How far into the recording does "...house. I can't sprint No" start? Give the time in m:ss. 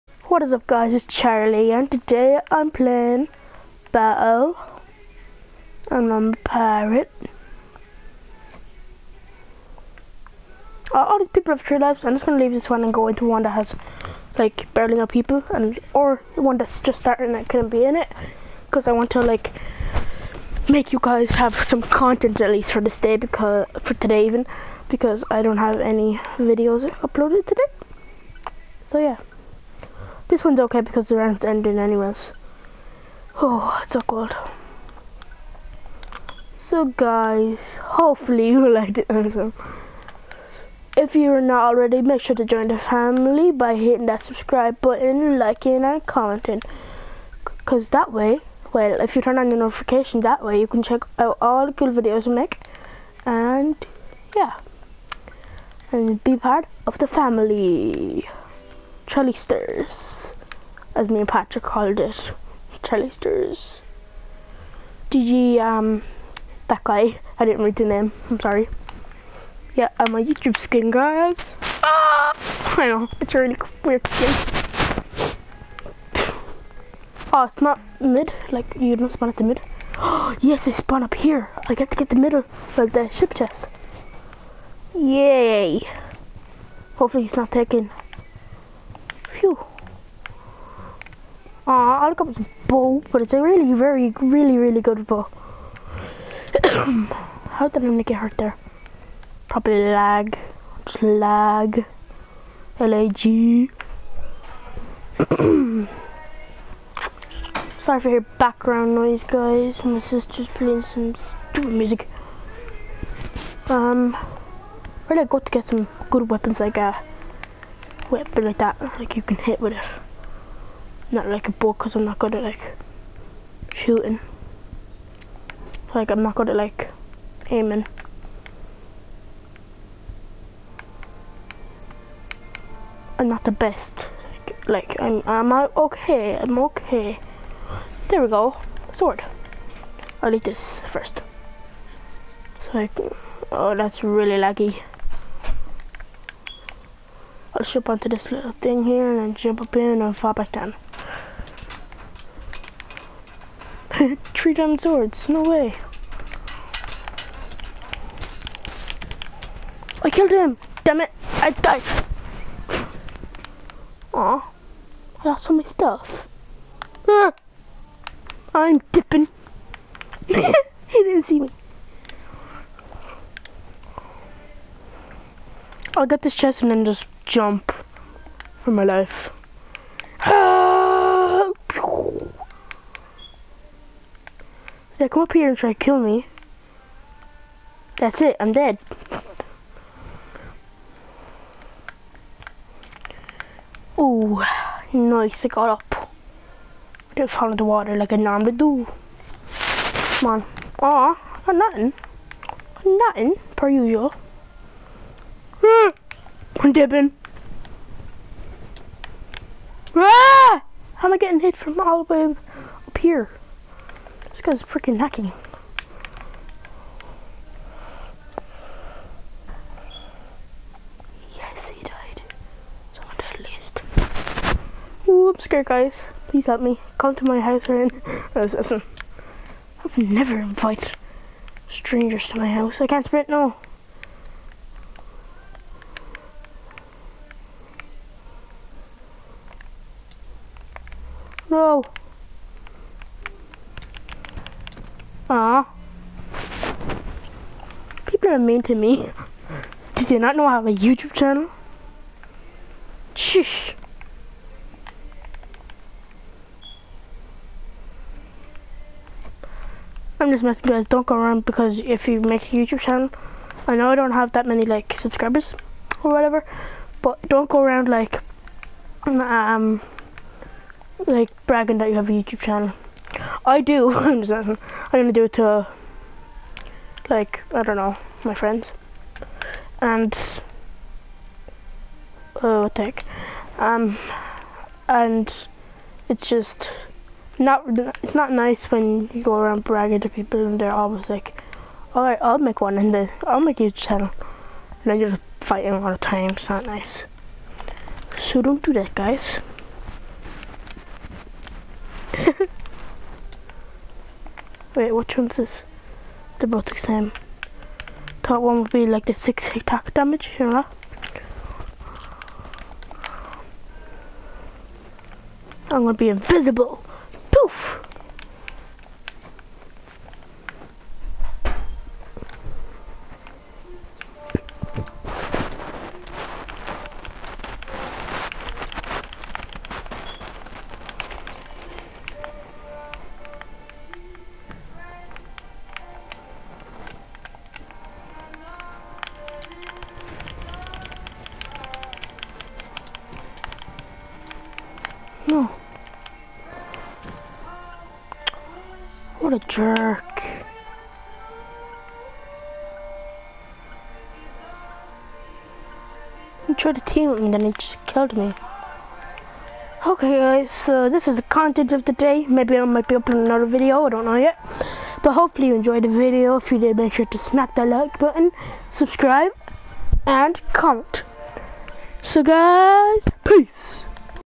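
3:52.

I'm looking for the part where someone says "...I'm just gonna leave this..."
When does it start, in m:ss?
0:12.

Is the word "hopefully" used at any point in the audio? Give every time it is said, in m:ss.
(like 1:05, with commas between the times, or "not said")
0:37, 1:26, 6:05.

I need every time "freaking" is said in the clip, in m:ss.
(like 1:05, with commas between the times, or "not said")
3:34.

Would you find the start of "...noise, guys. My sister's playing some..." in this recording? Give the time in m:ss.
1:48.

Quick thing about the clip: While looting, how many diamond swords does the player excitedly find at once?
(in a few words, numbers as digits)
3.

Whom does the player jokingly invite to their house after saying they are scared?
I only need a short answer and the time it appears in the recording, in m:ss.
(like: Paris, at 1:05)
Ryan, at 3:47.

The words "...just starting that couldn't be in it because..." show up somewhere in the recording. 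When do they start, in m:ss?
0:16.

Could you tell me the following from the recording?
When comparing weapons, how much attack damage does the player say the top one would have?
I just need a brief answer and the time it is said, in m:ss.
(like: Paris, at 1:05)
6, at 5:09.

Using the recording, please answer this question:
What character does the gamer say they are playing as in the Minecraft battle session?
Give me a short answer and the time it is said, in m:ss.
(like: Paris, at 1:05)
A pirate, at 0:06.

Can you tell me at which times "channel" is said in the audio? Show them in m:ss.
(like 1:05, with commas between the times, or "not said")
4:11, 4:22, 4:32, 4:53.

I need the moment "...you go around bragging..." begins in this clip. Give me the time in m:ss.
4:49.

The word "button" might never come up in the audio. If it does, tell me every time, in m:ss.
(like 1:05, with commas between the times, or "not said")
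0:44, 6:07.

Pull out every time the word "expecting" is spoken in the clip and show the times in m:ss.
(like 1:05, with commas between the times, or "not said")
not said.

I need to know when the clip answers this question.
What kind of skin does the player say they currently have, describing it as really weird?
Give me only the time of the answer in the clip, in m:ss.
1:10.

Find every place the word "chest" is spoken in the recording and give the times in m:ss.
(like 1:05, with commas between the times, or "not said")
1:23, 2:56.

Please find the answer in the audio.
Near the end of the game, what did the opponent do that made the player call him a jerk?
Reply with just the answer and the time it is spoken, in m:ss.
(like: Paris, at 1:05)
He tried to team, at 5:56.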